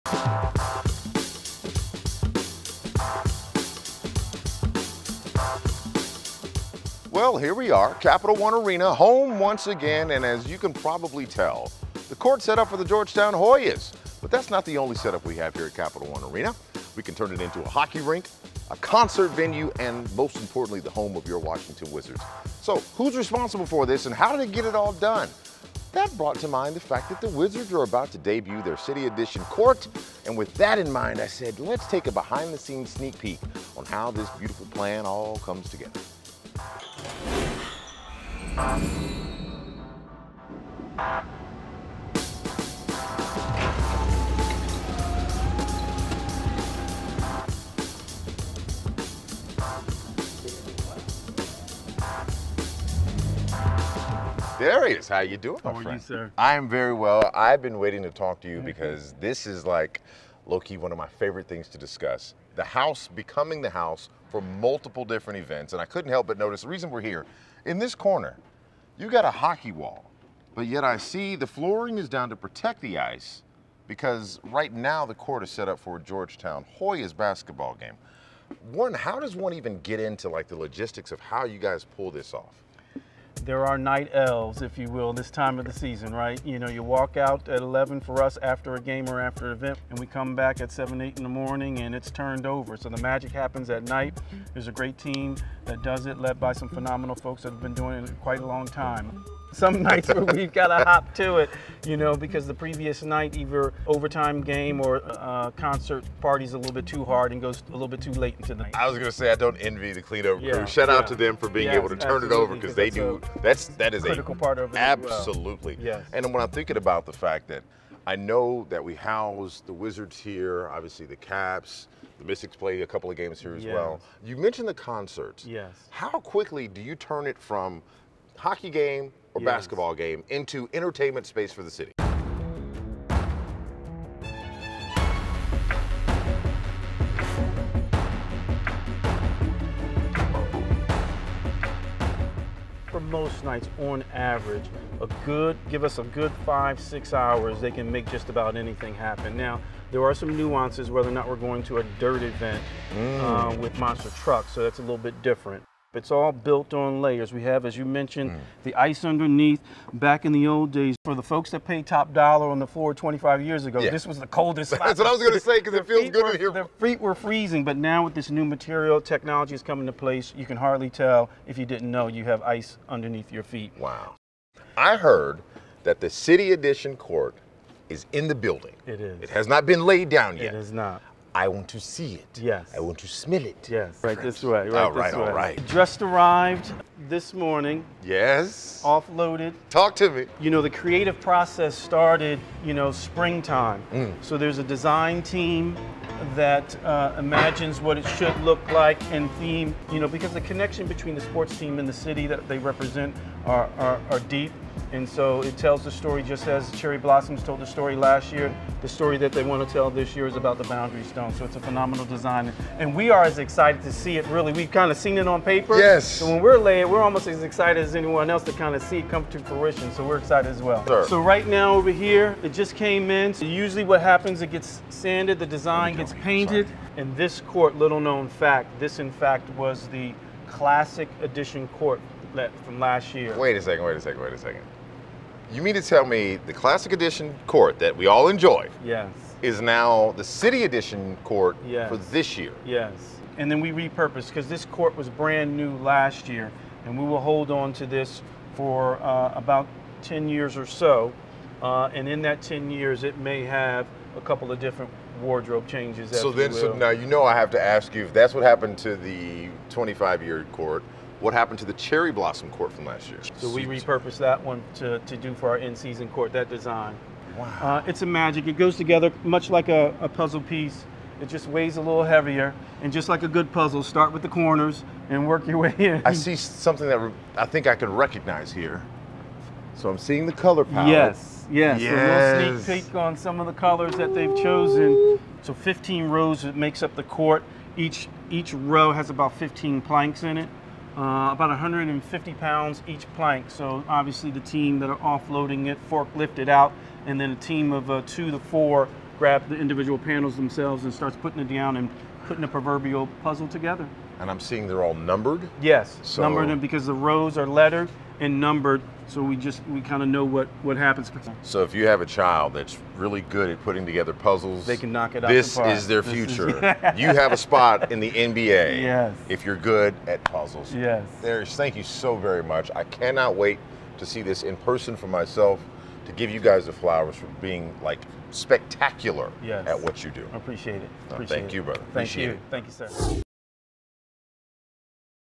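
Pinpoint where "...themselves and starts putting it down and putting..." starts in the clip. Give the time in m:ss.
5:00.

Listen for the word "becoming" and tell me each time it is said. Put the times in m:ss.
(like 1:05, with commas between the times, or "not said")
1:03.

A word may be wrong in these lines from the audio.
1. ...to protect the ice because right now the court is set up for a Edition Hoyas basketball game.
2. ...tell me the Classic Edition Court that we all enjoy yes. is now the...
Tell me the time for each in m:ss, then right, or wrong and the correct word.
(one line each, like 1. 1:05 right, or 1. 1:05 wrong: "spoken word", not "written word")
1. 1:12 wrong: "Georgetown", not "Edition"
2. 3:55 right.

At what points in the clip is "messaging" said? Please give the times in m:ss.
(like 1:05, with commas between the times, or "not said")
not said.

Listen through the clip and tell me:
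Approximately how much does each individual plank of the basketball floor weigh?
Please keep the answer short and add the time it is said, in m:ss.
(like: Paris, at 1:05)
150 pounds, at 4:51.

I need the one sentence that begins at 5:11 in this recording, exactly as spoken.
So if you have a child that's really good at putting together puzzles, they can knock it out.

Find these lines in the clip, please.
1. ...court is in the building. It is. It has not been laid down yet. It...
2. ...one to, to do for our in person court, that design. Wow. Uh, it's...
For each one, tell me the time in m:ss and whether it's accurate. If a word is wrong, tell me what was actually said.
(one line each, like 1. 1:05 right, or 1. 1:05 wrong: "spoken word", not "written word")
1. 2:56 right
2. 4:24 wrong: "season", not "person".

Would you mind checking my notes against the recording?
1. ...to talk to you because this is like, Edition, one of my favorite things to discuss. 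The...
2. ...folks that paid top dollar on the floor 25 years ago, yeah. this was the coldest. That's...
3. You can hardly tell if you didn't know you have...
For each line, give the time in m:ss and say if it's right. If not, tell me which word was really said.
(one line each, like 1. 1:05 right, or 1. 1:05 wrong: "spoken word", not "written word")
1. 0:58 wrong: "Loki", not "Edition"
2. 2:41 right
3. 2:50 right.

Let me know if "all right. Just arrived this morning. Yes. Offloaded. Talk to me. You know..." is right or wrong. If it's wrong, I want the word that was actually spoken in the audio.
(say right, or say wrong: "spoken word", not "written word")
right.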